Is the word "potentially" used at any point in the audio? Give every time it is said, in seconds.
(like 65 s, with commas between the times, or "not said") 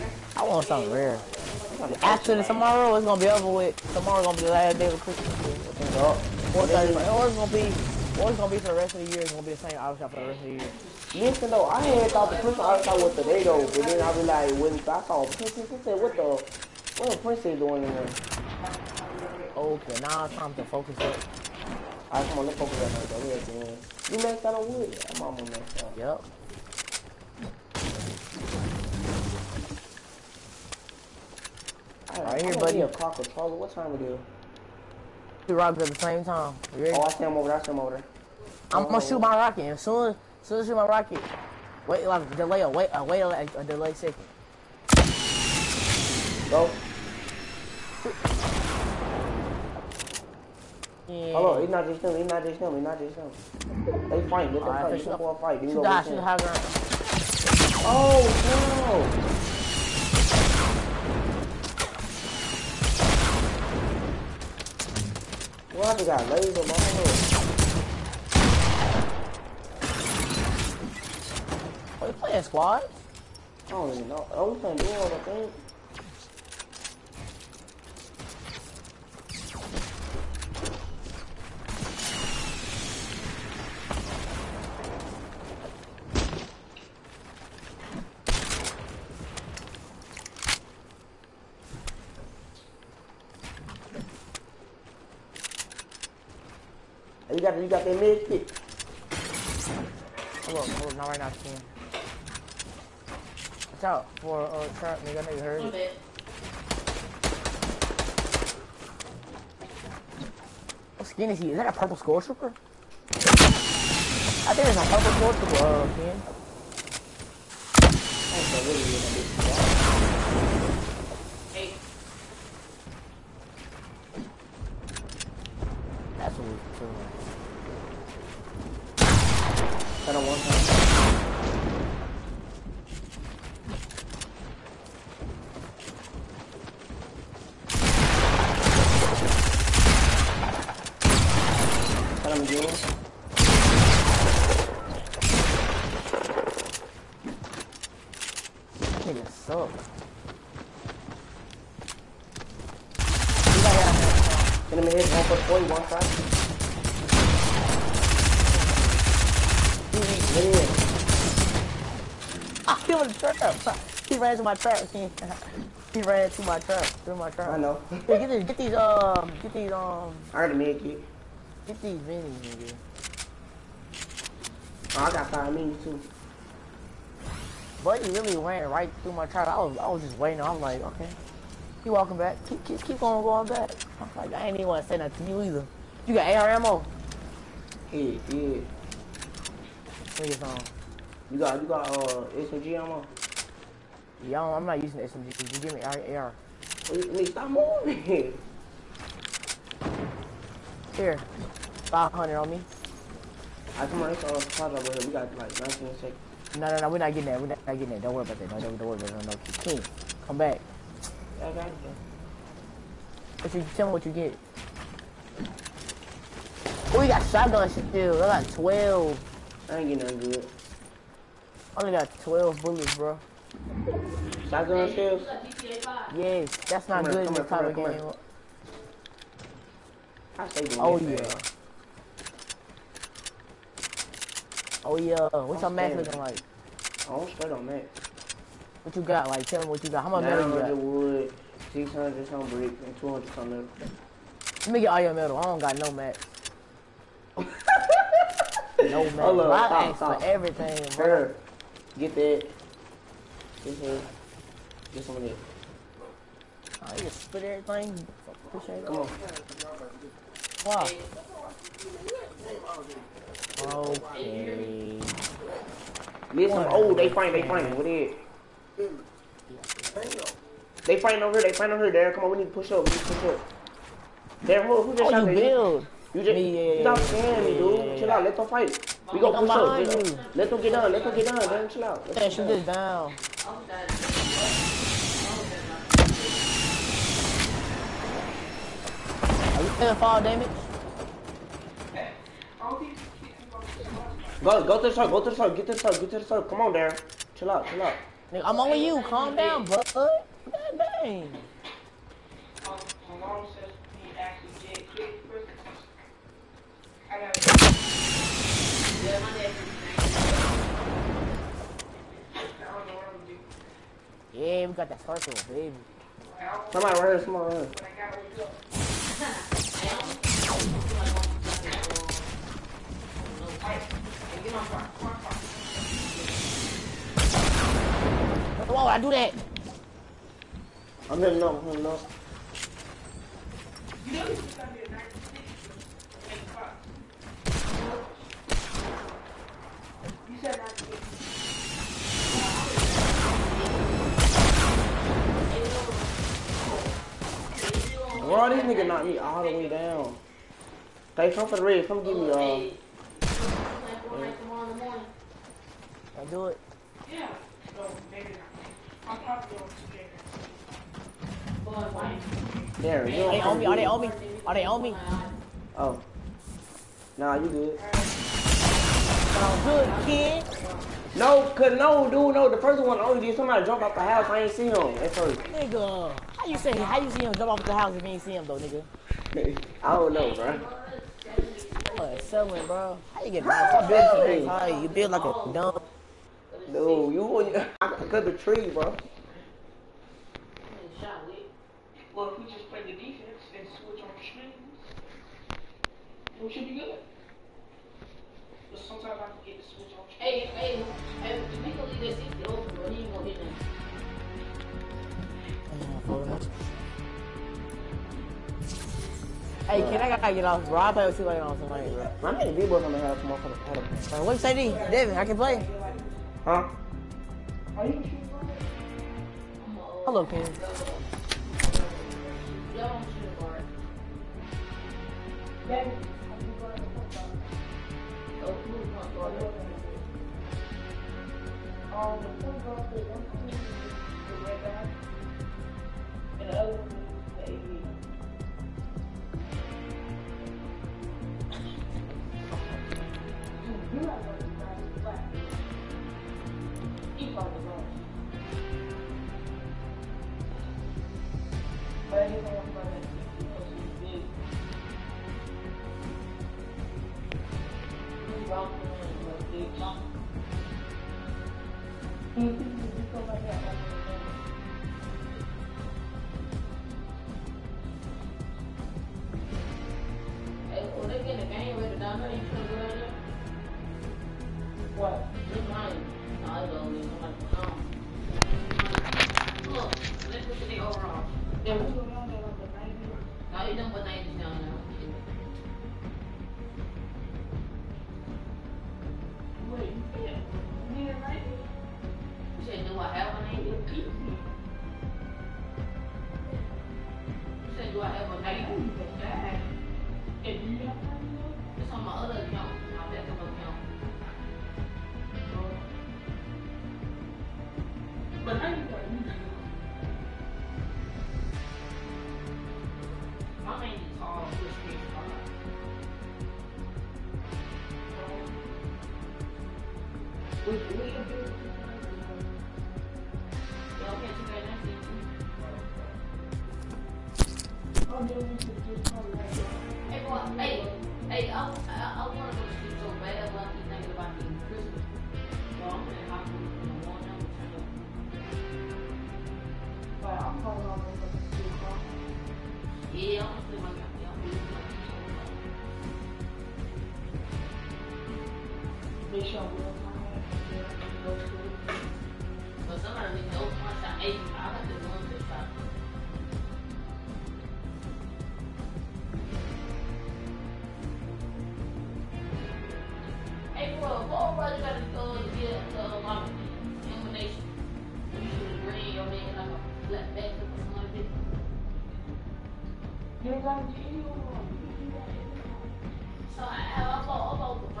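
not said.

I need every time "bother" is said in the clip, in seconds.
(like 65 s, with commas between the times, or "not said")
not said.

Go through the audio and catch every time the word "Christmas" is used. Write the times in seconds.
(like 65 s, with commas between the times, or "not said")
5 s, 12 s.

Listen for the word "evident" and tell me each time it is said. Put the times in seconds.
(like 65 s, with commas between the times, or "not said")
not said.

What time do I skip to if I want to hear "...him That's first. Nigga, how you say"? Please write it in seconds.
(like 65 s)
374 s.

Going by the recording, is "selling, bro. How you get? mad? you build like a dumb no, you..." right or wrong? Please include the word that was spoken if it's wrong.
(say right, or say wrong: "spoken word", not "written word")
right.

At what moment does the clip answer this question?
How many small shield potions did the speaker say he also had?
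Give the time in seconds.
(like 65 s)
175 s.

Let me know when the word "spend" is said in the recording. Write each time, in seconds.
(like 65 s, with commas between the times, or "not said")
237 s.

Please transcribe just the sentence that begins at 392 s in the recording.
Well, if we just play the defense and switch on strings, we should be good.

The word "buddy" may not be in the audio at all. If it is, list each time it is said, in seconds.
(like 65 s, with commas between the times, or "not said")
32 s.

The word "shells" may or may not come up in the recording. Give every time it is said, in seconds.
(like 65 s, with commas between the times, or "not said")
224 s.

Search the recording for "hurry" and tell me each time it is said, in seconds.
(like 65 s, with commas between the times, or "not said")
105 s.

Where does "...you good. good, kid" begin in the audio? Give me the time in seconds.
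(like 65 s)
367 s.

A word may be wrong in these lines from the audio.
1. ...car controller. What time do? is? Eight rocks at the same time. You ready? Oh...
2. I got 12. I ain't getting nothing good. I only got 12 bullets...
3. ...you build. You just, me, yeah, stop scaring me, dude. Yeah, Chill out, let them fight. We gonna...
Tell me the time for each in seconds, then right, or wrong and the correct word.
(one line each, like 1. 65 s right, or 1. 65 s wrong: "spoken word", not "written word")
1. 32 s wrong: "Two", not "Eight"
2. 218 s right
3. 275 s right.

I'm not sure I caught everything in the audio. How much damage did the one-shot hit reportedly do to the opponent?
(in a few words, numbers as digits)
40.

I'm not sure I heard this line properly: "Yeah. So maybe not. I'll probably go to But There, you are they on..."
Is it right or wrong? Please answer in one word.
right.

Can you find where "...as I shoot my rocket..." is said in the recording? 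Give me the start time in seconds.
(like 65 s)
40 s.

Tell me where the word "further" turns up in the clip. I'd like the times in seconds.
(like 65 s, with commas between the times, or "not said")
not said.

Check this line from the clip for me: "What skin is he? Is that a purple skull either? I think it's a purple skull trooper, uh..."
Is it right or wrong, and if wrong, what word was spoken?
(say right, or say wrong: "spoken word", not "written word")
wrong: "trooper", not "either".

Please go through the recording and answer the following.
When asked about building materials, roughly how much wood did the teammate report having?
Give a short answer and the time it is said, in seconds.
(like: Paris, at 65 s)
600, at 241 s.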